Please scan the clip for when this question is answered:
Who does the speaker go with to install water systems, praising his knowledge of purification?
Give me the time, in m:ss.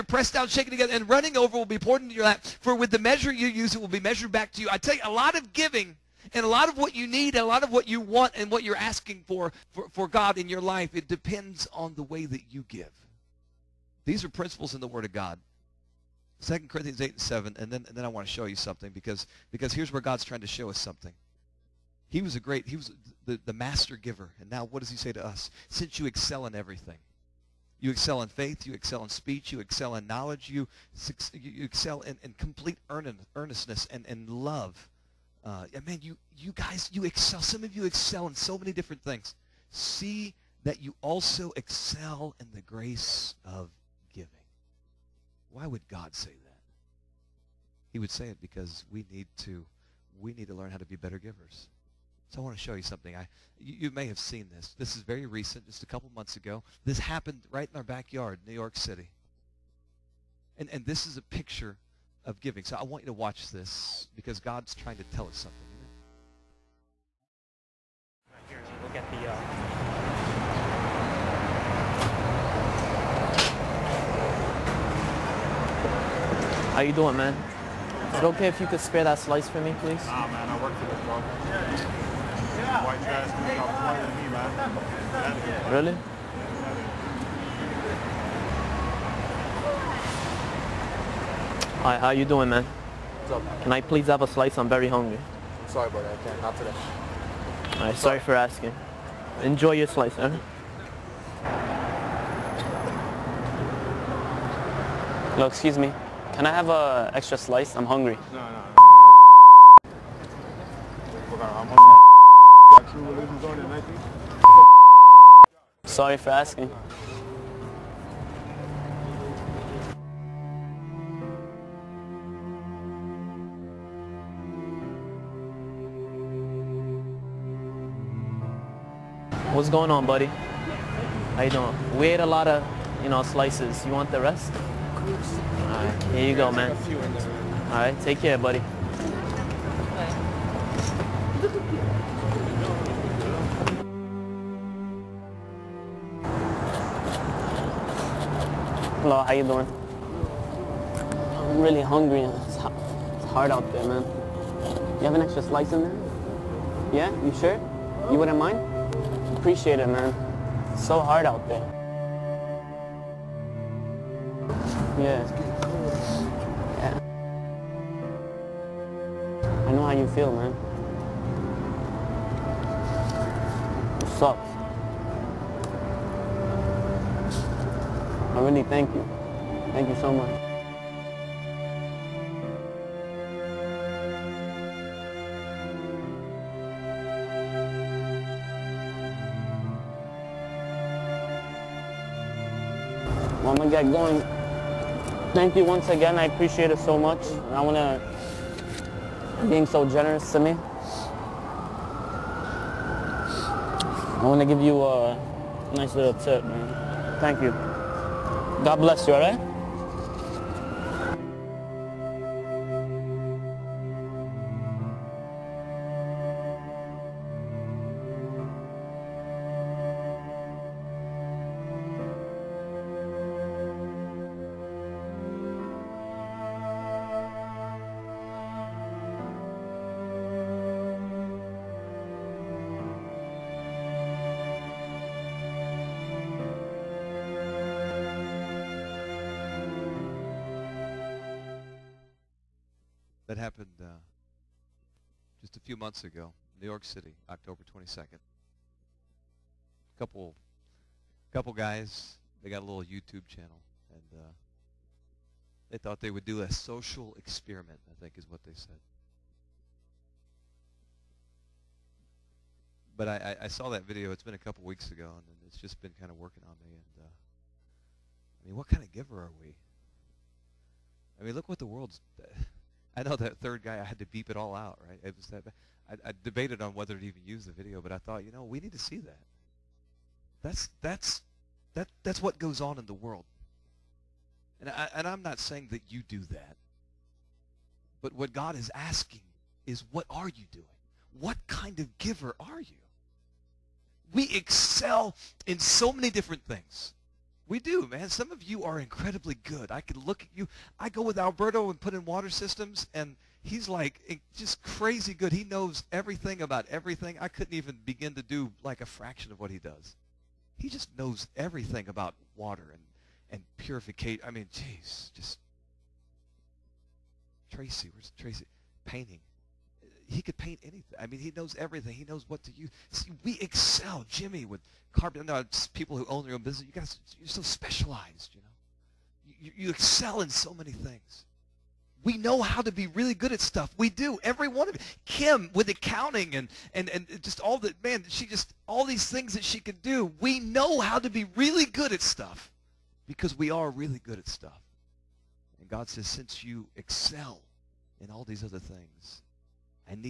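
5:01.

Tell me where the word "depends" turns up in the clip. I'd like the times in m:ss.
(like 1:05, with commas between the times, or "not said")
0:11.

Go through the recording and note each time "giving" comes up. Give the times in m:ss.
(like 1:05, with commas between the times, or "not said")
0:05, 1:02.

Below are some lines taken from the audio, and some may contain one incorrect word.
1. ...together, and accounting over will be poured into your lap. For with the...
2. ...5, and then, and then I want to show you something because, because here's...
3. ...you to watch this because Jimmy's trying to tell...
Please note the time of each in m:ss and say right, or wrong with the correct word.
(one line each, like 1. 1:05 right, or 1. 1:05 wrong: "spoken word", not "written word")
1. 0:00 wrong: "running", not "accounting"
2. 0:17 wrong: "7", not "5"
3. 1:03 wrong: "God", not "Jimmy".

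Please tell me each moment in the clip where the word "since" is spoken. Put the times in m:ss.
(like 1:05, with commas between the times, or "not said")
0:25, 5:46.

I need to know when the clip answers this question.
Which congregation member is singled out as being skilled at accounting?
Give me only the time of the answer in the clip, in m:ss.
5:35.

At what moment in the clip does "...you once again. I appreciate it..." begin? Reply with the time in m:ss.
3:15.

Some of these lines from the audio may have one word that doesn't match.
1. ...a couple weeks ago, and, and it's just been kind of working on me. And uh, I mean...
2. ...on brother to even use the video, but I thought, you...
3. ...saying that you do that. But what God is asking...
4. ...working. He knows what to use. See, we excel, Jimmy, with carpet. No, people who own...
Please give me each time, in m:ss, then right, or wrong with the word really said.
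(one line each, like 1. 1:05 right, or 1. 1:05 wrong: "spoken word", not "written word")
1. 4:24 right
2. 4:36 wrong: "whether", not "brother"
3. 4:45 right
4. 5:21 wrong: "everything", not "working".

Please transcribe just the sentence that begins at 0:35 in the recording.
Uh, man, you, you guys, you excel.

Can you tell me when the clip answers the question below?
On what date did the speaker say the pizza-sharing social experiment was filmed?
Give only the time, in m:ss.
4:07.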